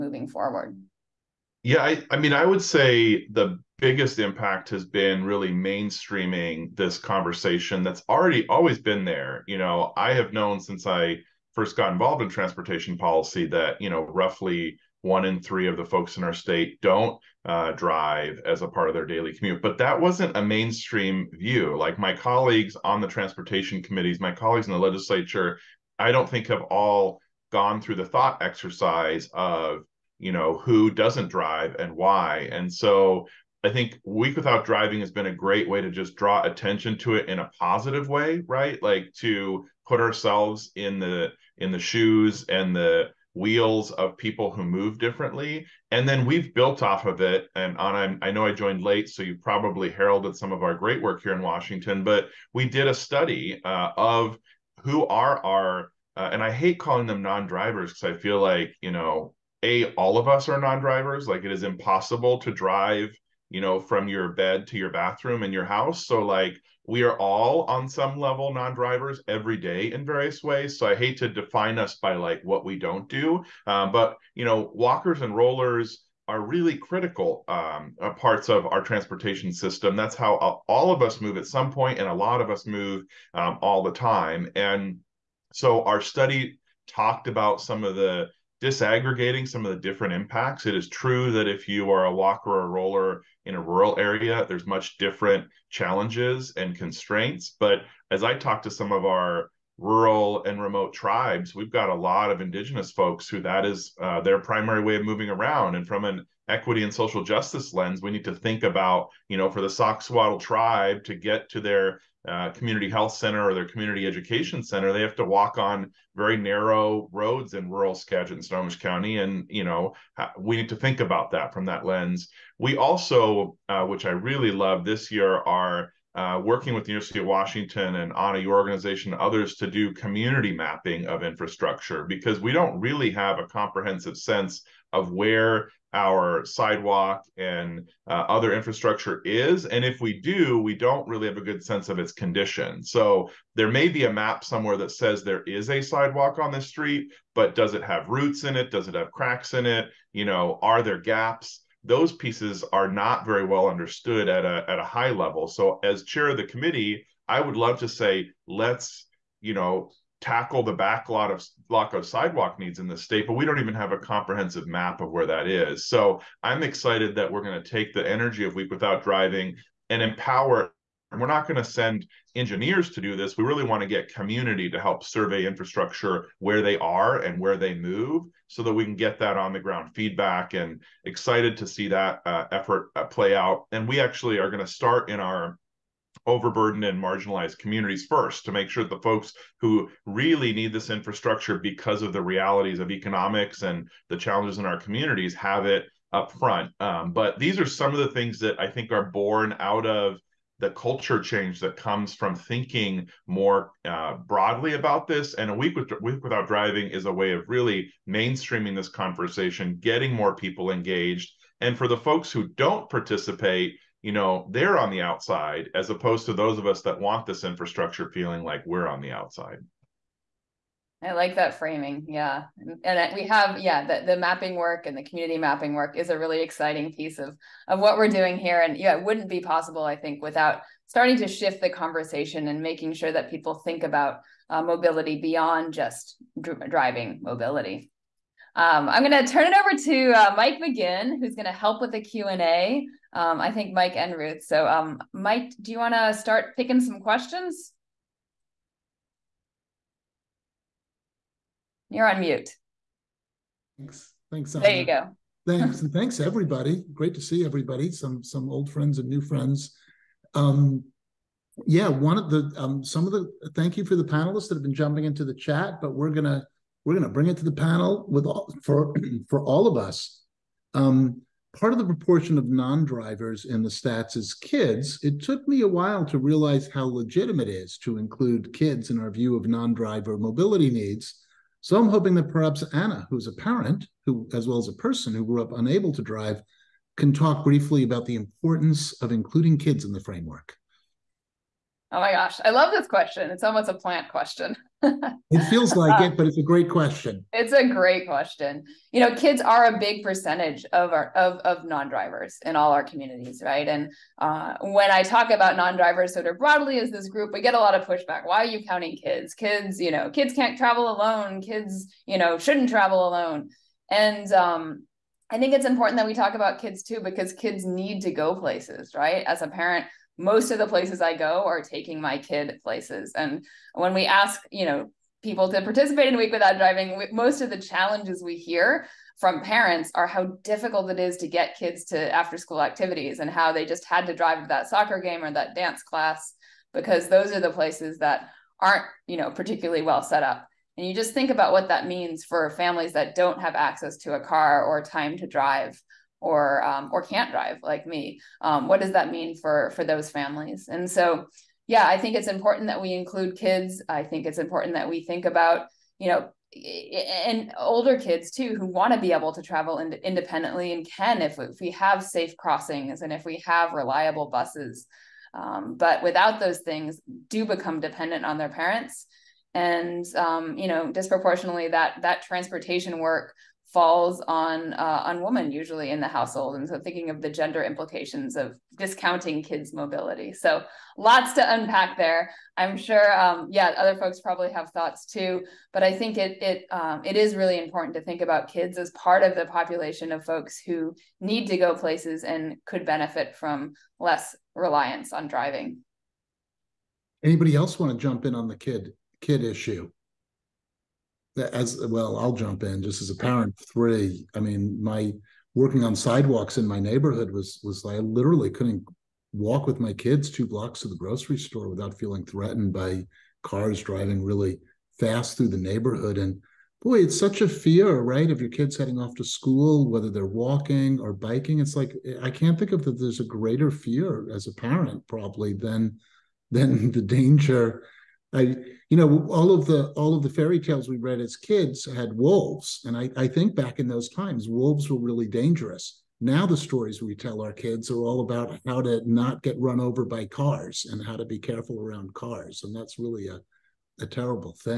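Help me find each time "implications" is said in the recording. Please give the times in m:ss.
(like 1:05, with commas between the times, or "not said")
6:17.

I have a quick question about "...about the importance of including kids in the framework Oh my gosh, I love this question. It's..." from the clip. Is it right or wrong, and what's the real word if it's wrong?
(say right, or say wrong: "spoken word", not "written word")
right.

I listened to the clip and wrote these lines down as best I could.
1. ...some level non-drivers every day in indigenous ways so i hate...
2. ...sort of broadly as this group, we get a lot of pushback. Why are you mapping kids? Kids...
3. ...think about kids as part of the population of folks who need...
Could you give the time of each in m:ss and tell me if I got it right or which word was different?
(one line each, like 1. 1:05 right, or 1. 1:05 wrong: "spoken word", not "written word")
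1. 1:07 wrong: "various", not "indigenous"
2. 5:06 wrong: "counting", not "mapping"
3. 6:28 right.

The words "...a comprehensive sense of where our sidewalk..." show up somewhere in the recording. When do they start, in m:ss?
2:13.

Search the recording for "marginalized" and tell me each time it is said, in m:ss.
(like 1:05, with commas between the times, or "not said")
3:07.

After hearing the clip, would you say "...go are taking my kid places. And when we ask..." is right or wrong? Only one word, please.
right.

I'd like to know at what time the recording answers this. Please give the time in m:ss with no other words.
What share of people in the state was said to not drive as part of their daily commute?
0:15.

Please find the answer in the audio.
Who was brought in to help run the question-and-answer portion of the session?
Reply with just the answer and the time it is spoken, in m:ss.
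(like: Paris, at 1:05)
Mike McGinn, at 4:00.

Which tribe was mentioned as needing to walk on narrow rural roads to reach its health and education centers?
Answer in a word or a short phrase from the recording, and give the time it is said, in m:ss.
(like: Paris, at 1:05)
Sauk-Suiattle, at 1:49.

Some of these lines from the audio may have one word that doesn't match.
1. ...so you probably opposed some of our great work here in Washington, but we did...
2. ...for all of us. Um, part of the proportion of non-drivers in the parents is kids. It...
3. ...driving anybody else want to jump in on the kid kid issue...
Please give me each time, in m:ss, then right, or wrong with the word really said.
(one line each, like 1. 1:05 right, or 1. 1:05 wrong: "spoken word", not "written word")
1. 0:49 wrong: "heralded", not "opposed"
2. 4:29 wrong: "stats", not "parents"
3. 6:35 right.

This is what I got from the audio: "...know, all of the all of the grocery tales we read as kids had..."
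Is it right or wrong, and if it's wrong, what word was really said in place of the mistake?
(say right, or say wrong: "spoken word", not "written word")
wrong: "fairy", not "grocery".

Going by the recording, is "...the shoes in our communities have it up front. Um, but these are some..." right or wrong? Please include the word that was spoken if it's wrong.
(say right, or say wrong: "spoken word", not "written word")
wrong: "challenges", not "shoes".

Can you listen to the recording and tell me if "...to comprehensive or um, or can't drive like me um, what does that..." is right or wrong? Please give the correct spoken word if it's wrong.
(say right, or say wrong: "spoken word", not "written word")
wrong: "drive", not "comprehensive".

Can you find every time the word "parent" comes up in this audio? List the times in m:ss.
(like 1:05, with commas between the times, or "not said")
4:43, 5:19, 5:29, 6:08, 6:43, 7:04.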